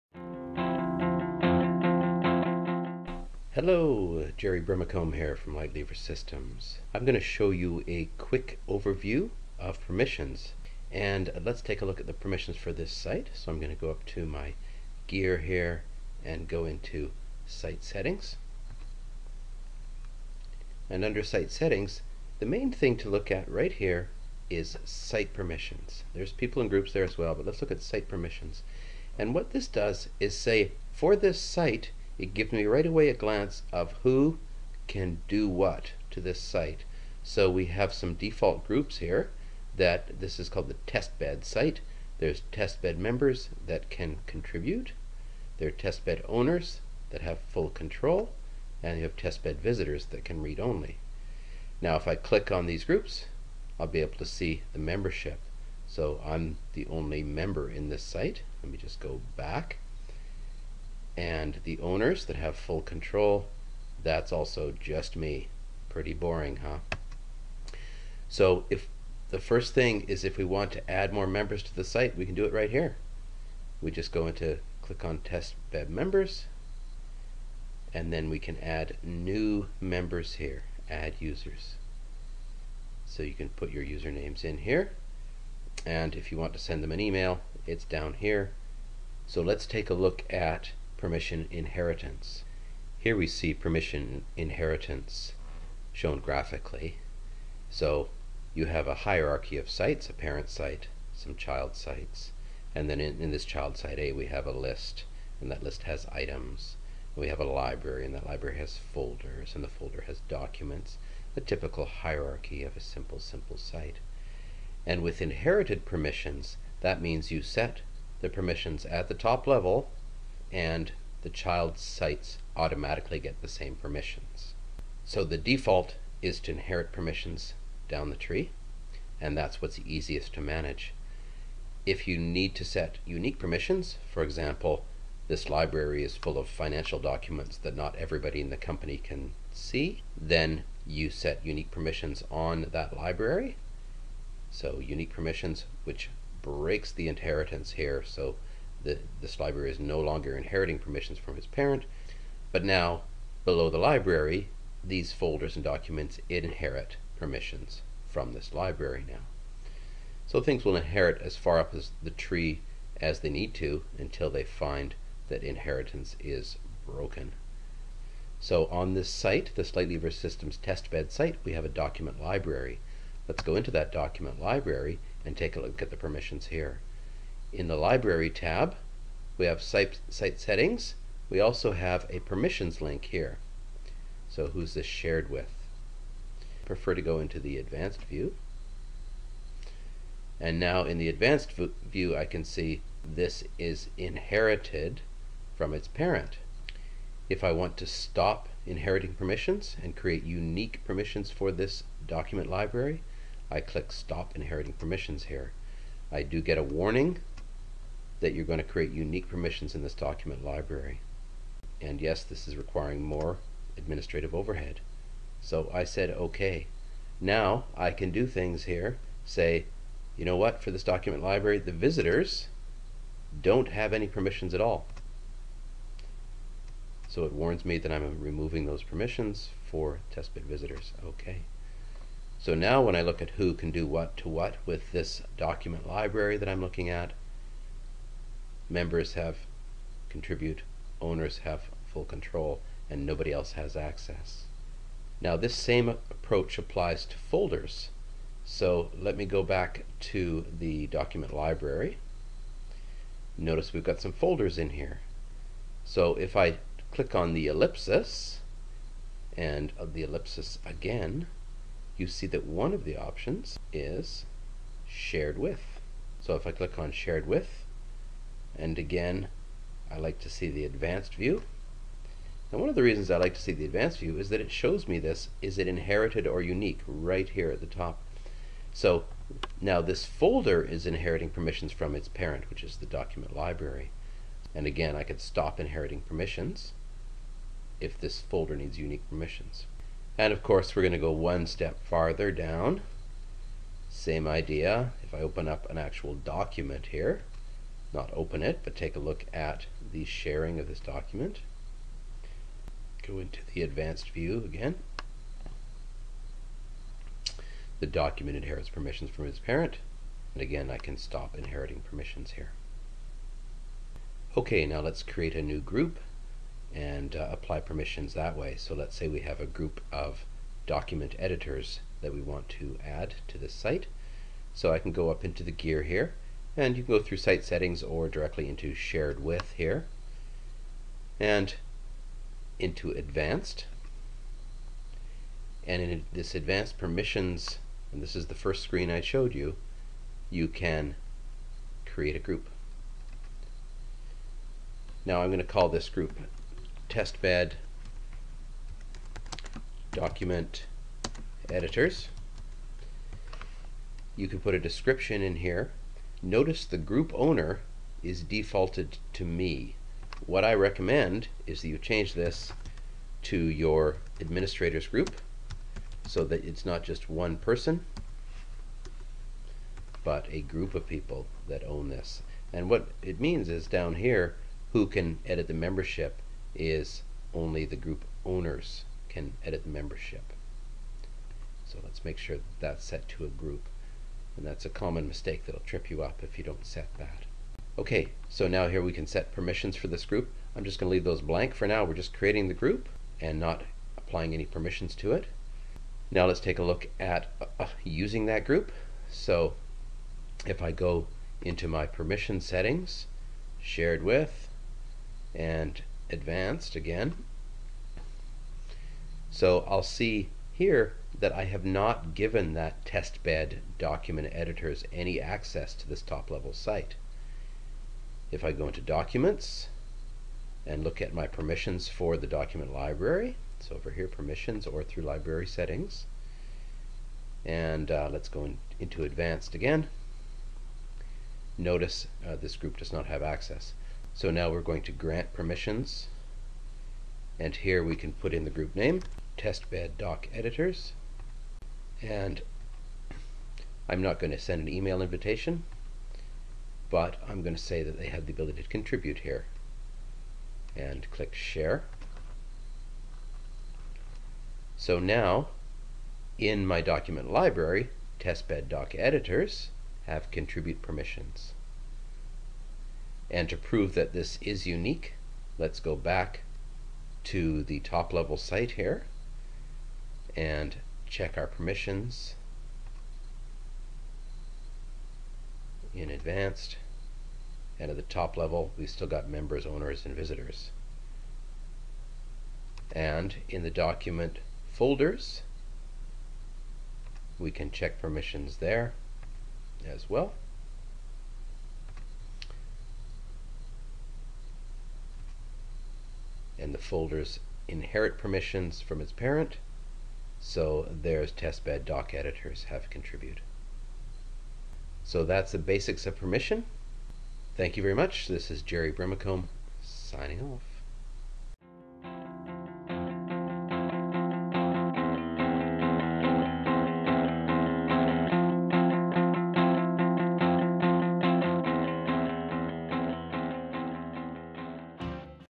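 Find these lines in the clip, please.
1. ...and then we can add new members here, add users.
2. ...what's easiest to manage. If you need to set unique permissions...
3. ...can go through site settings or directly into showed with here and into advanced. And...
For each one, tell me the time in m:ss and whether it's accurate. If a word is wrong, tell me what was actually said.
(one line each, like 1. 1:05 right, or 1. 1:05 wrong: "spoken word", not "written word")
1. 1:17 right
2. 2:09 right
3. 5:26 wrong: "shared", not "showed".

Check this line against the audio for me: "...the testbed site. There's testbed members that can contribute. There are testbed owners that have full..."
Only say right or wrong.
right.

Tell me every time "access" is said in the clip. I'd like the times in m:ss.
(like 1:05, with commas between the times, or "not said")
4:03, 6:55, 7:13.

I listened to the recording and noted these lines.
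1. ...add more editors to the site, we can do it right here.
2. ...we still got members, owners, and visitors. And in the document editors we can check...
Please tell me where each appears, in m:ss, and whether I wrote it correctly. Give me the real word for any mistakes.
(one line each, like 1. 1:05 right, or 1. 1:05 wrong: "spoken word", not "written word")
1. 1:10 wrong: "members", not "editors"
2. 7:58 wrong: "folders", not "editors".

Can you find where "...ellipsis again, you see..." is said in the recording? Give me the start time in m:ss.
4:20.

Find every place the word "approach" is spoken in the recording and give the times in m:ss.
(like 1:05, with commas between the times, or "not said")
4:05.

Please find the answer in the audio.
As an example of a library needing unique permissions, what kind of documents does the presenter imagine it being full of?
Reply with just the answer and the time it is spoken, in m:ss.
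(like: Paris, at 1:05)
Financial documents, at 2:16.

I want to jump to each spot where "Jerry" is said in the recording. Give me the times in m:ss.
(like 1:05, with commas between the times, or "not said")
0:04, 8:28.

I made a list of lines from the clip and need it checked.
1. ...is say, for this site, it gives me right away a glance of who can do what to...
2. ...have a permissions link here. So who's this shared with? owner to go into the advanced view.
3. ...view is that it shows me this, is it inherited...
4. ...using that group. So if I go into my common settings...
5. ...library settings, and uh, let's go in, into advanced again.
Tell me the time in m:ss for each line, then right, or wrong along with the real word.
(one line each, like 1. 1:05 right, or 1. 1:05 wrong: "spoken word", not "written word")
1. 0:30 right
2. 3:01 wrong: "prefer", not "owner"
3. 4:33 right
4. 6:37 wrong: "permission", not "common"
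5. 7:05 right.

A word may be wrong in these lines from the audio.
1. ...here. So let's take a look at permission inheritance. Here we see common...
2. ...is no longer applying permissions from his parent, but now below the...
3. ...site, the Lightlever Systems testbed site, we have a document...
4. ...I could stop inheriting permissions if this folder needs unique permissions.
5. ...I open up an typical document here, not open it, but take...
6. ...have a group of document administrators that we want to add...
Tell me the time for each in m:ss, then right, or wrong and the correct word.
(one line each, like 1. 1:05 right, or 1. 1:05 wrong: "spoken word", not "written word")
1. 1:28 wrong: "permission", not "common"
2. 2:29 wrong: "inheriting", not "applying"
3. 2:49 right
4. 4:44 right
5. 4:55 wrong: "actual", not "typical"
6. 5:19 wrong: "editors", not "administrators".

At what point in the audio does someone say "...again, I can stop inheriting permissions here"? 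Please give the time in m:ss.
5:10.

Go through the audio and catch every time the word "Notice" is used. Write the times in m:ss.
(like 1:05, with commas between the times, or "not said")
4:13, 5:56, 7:11.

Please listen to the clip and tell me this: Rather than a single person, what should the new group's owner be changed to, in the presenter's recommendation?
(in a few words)
Administrators group.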